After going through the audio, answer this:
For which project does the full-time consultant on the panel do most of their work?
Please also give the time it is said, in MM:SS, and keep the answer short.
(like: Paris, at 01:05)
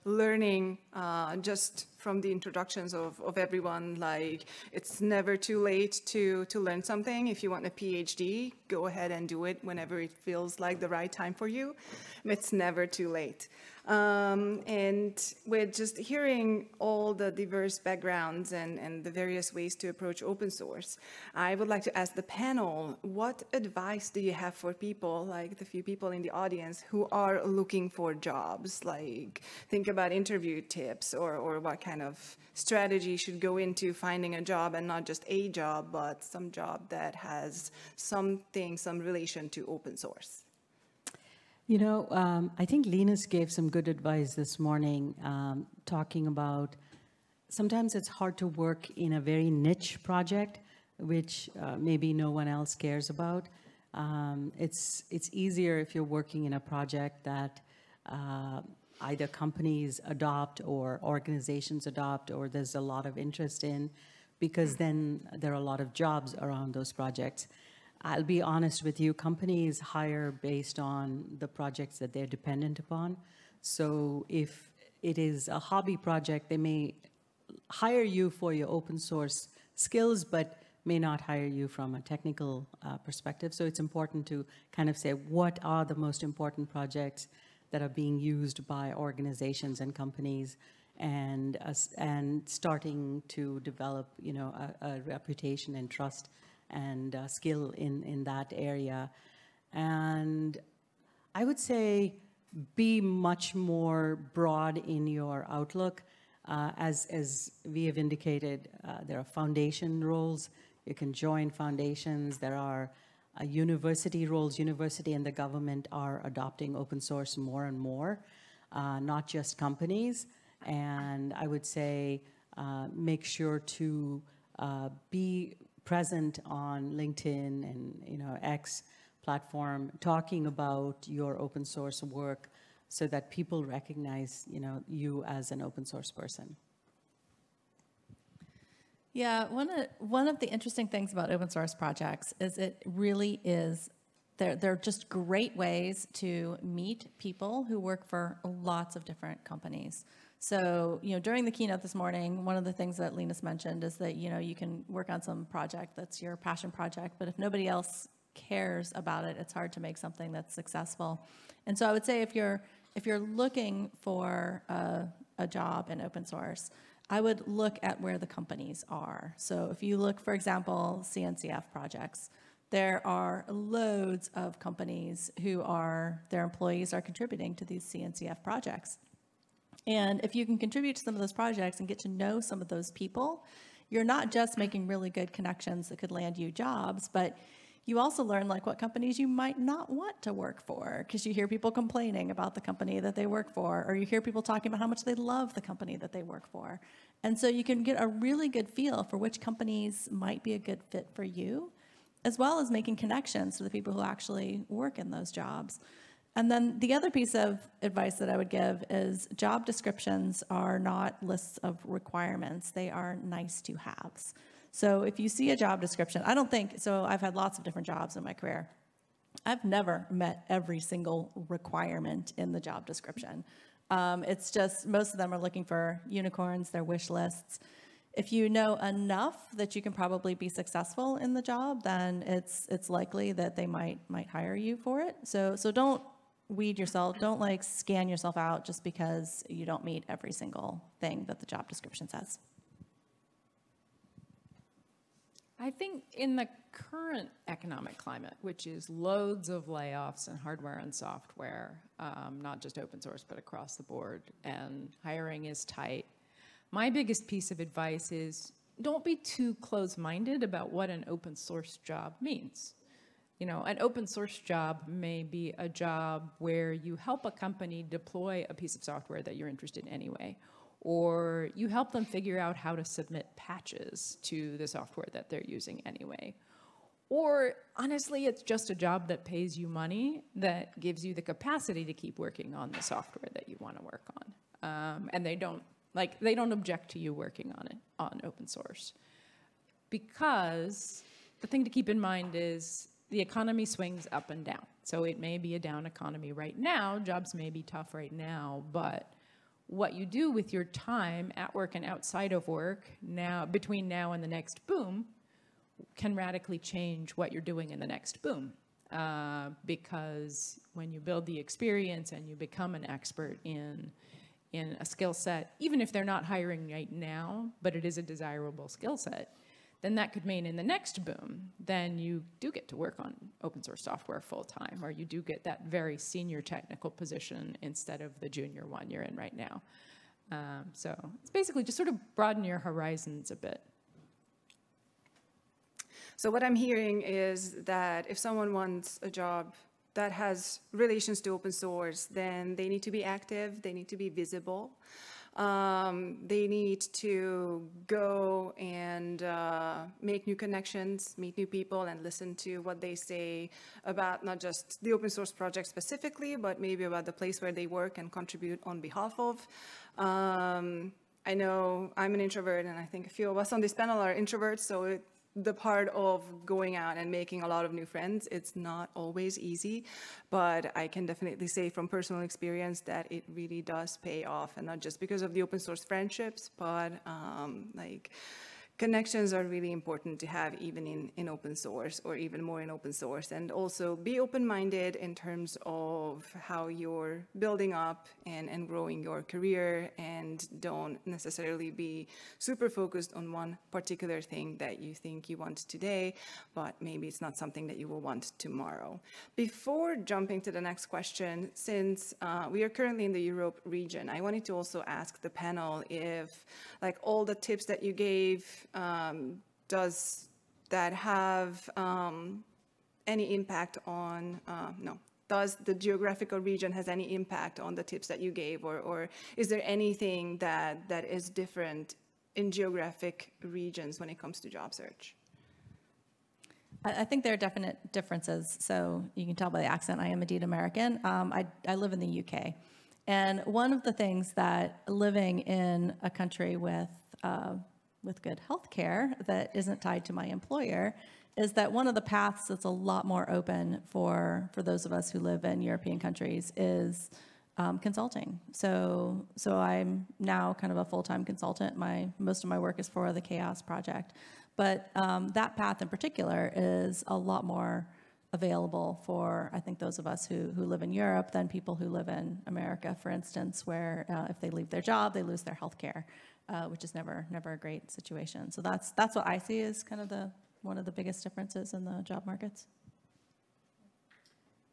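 CHAOSS, at 07:33.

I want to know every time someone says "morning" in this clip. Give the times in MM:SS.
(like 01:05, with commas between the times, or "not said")
00:44, 02:31.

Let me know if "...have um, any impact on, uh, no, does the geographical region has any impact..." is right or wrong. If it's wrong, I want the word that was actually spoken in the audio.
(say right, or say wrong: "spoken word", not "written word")
right.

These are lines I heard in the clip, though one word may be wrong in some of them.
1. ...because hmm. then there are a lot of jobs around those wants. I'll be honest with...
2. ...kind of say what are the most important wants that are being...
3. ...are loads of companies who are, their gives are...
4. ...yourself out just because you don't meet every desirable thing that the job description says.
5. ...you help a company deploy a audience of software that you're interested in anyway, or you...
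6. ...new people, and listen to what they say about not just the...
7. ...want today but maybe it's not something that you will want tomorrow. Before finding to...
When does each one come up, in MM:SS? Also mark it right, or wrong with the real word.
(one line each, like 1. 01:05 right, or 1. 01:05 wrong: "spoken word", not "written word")
1. 01:04 wrong: "projects", not "wants"
2. 01:24 wrong: "projects", not "wants"
3. 02:53 wrong: "employees", not "gives"
4. 03:58 wrong: "single", not "desirable"
5. 04:26 wrong: "piece", not "audience"
6. 05:51 right
7. 06:35 wrong: "jumping", not "finding".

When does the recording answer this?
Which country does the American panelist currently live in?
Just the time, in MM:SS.
07:12.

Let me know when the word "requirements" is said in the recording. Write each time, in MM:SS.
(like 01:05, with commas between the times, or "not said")
03:31, 03:41.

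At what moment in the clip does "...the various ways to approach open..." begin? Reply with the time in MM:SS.
00:19.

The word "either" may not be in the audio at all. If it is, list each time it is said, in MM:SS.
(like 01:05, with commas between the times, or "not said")
00:58.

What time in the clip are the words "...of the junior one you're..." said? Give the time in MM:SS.
05:27.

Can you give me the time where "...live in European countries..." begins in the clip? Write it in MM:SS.
07:25.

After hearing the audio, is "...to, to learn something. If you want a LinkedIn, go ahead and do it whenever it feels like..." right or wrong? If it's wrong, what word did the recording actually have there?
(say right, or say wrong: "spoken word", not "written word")
wrong: "PhD", not "LinkedIn".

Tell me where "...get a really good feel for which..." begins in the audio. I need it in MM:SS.
03:17.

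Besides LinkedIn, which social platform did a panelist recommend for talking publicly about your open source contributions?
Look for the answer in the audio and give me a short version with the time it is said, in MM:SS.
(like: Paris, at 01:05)
X, at 02:08.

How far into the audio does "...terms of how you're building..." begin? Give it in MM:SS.
06:25.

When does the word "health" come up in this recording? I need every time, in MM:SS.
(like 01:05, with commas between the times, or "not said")
07:18, 07:45.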